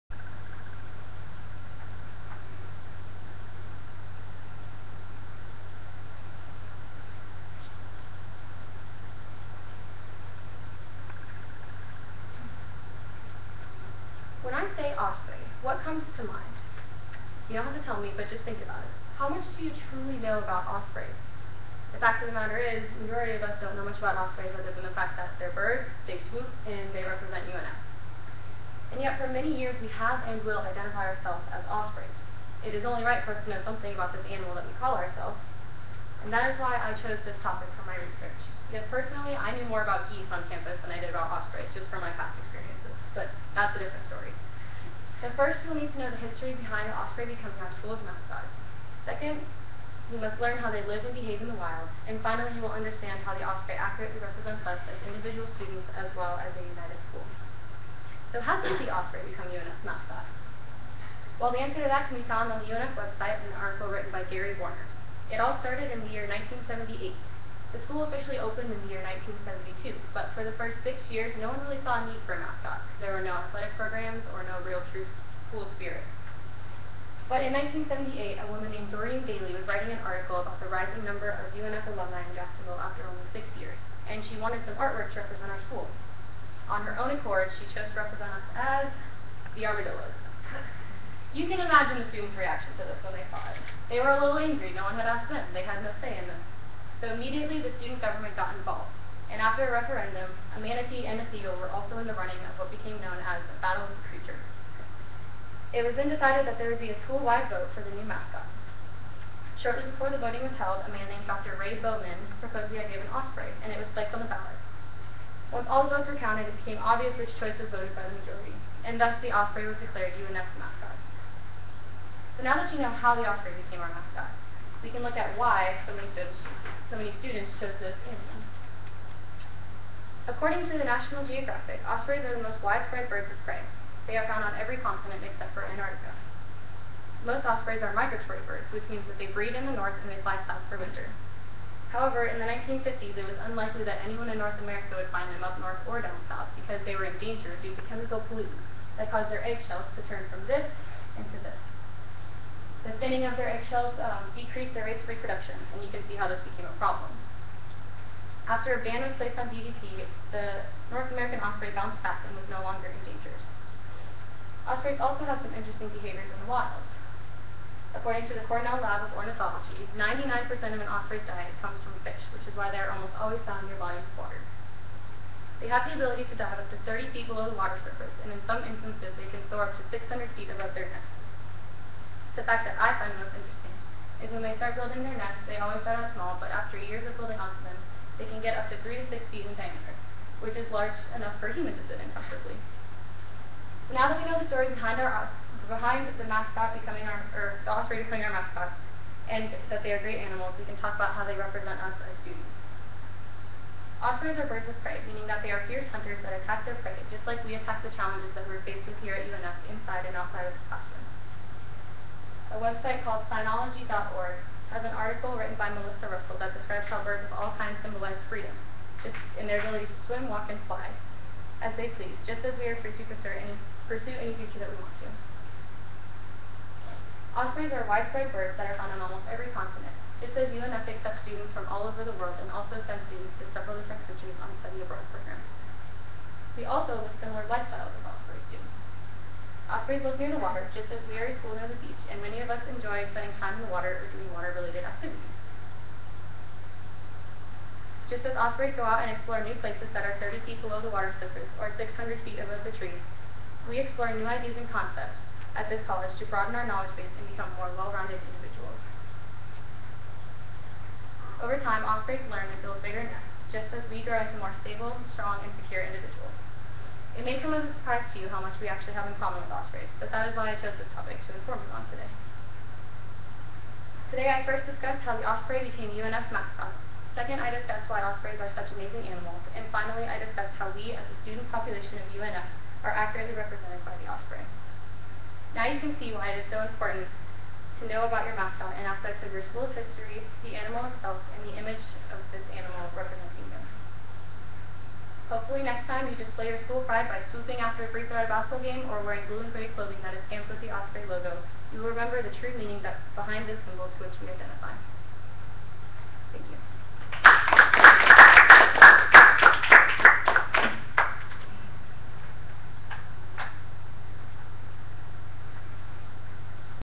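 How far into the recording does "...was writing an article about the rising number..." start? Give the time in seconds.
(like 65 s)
79 s.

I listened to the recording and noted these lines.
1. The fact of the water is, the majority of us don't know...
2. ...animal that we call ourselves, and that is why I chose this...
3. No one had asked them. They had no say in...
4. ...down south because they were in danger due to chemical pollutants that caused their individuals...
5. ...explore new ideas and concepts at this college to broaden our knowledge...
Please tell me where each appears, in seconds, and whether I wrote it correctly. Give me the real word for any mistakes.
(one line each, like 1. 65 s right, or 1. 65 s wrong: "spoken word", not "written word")
1. 21 s wrong: "matter", not "water"
2. 34 s right
3. 94 s right
4. 146 s wrong: "eggshells", not "individuals"
5. 253 s right.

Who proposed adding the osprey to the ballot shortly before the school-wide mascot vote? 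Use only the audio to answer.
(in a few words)
Dr. Ray Bowman.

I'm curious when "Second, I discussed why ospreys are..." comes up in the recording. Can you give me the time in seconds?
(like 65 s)
277 s.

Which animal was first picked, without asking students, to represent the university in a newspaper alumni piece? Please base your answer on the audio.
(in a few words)
armadillos.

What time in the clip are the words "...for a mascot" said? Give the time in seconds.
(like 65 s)
72 s.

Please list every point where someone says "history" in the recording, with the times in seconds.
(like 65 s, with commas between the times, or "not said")
46 s, 289 s.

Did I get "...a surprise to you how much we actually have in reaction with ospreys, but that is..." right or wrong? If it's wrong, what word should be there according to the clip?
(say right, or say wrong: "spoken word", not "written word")
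wrong: "common", not "reaction".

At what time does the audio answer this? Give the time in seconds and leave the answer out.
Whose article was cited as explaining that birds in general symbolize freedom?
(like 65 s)
215 s.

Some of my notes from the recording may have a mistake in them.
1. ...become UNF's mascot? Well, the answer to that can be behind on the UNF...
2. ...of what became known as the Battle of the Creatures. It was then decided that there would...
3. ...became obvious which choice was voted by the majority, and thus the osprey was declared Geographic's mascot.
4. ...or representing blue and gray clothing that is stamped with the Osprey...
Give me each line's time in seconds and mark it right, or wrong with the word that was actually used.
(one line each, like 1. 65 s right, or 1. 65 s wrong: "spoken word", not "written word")
1. 59 s wrong: "found", not "behind"
2. 102 s right
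3. 116 s wrong: "UNF", not "Geographic"
4. 298 s wrong: "wearing", not "representing".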